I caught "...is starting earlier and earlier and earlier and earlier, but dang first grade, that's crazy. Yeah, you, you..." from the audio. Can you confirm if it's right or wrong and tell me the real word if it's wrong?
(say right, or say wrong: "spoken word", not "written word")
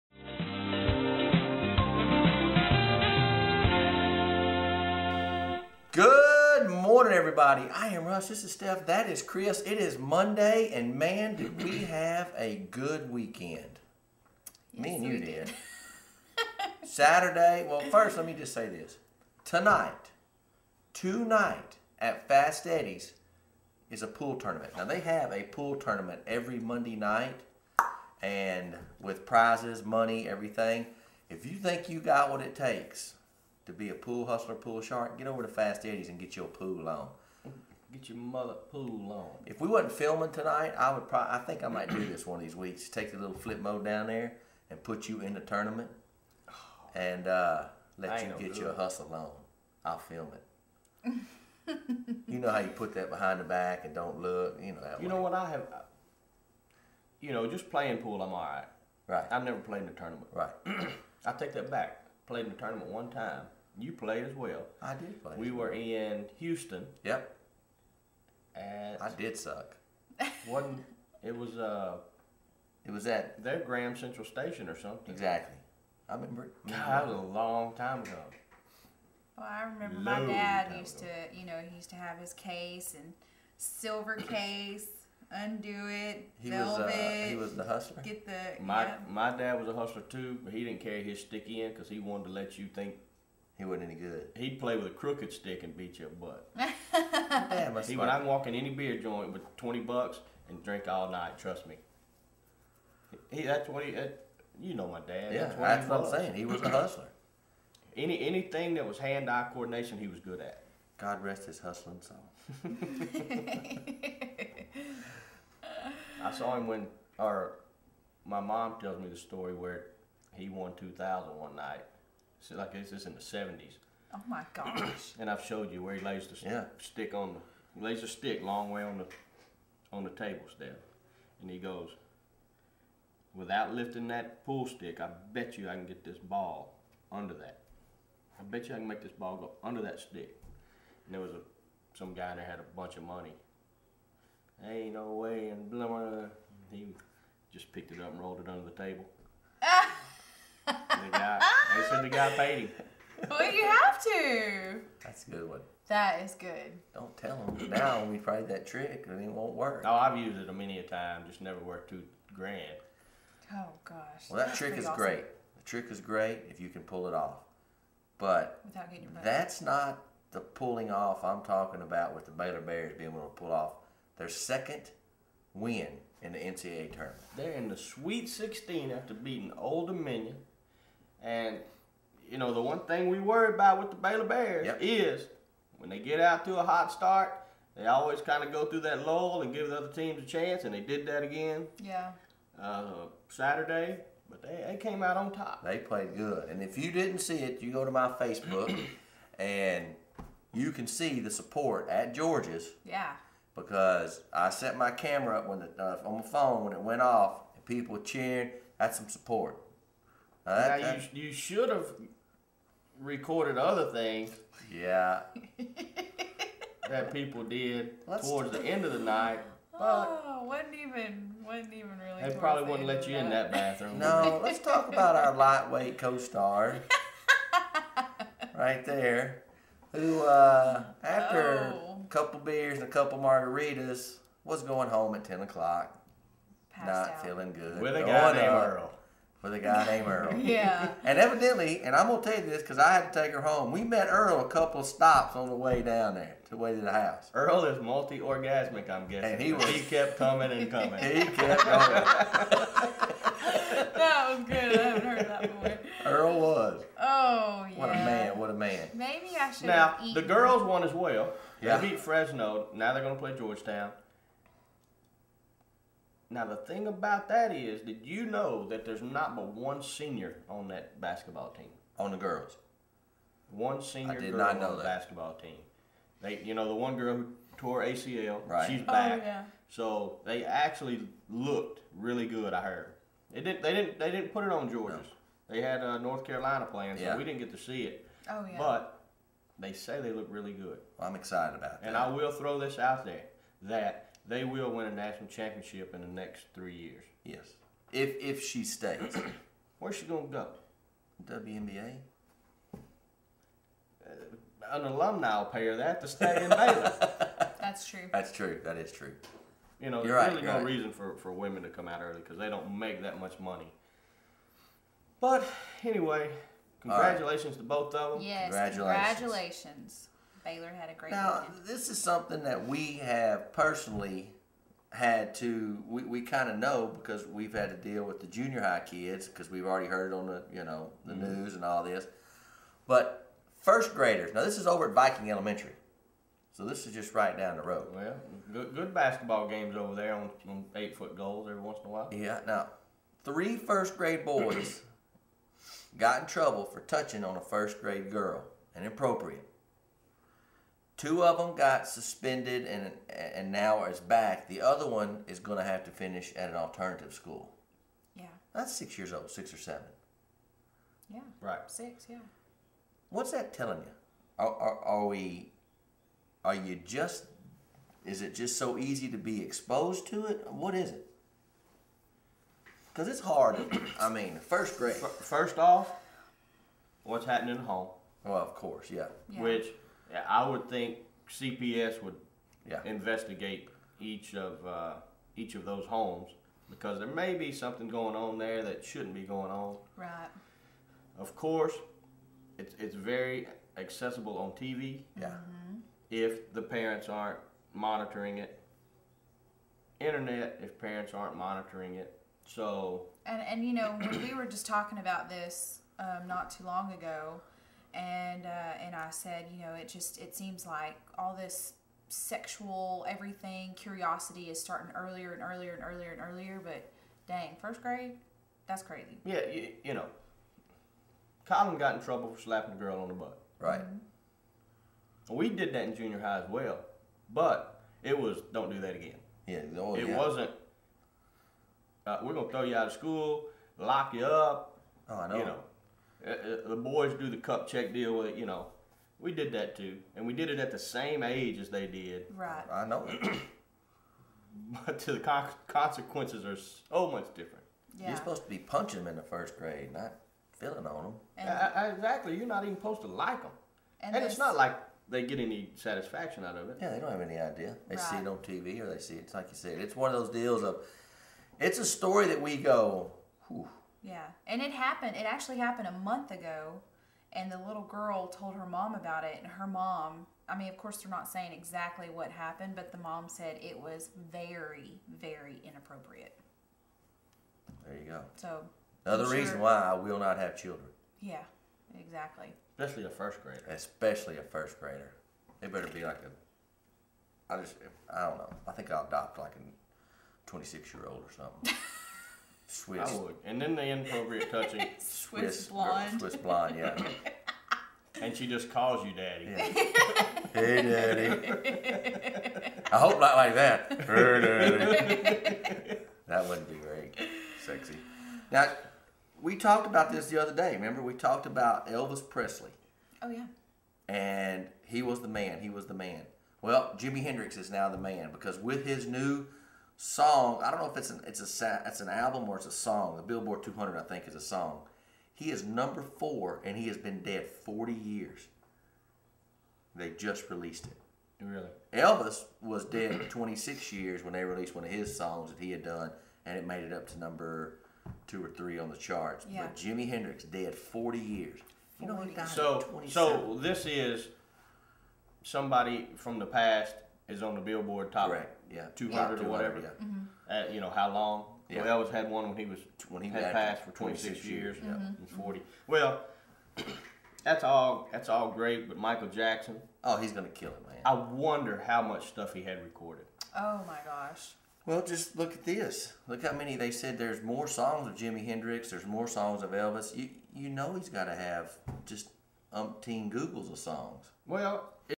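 right.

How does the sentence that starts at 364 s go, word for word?
Are, are, are we, are you just, is it just so easy to be exposed to it?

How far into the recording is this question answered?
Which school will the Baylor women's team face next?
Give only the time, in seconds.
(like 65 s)
263 s.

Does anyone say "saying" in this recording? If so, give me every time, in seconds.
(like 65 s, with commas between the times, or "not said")
106 s, 471 s.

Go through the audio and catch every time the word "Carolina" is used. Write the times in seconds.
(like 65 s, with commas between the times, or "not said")
286 s.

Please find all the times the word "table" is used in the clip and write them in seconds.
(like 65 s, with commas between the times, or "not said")
130 s, 148 s.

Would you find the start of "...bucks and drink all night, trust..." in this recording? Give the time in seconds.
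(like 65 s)
99 s.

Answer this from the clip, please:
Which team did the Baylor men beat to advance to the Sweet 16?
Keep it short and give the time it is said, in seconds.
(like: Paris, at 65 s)
Old Dominion, at 179 s.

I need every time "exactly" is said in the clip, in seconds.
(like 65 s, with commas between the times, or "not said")
75 s, 451 s, 471 s, 481 s.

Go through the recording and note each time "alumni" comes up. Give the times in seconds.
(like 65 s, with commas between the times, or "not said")
304 s.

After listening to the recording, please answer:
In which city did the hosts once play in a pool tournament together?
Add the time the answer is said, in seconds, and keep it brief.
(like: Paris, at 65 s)
Houston, at 66 s.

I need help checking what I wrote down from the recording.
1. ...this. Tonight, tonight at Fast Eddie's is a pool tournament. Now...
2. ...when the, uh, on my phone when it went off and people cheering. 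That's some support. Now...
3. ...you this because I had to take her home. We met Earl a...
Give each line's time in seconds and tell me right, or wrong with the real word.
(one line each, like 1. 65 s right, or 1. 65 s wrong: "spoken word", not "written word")
1. 18 s right
2. 205 s right
3. 242 s right.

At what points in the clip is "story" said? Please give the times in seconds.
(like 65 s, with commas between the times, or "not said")
119 s, 461 s.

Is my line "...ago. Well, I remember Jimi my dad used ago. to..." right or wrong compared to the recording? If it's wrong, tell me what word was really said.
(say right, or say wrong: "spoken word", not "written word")
wrong: "Low", not "Jimi".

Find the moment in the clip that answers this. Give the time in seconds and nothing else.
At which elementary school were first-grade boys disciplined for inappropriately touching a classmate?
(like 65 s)
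334 s.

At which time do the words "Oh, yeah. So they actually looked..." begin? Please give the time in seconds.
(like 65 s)
279 s.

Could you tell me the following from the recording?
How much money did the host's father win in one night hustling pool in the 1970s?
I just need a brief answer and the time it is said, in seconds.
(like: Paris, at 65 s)
2000, at 120 s.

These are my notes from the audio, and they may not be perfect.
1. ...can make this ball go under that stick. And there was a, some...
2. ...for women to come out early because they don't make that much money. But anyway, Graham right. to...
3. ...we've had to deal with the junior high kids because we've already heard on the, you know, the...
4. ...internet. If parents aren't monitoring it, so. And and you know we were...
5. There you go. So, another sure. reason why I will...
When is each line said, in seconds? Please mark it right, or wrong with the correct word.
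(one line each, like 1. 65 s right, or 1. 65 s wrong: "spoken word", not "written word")
1. 138 s right
2. 311 s wrong: "Congratulations", not "Graham"
3. 327 s right
4. 400 s right
5. 477 s right.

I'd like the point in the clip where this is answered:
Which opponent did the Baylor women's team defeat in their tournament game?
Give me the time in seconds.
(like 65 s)
261 s.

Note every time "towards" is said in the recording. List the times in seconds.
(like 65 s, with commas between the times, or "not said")
218 s.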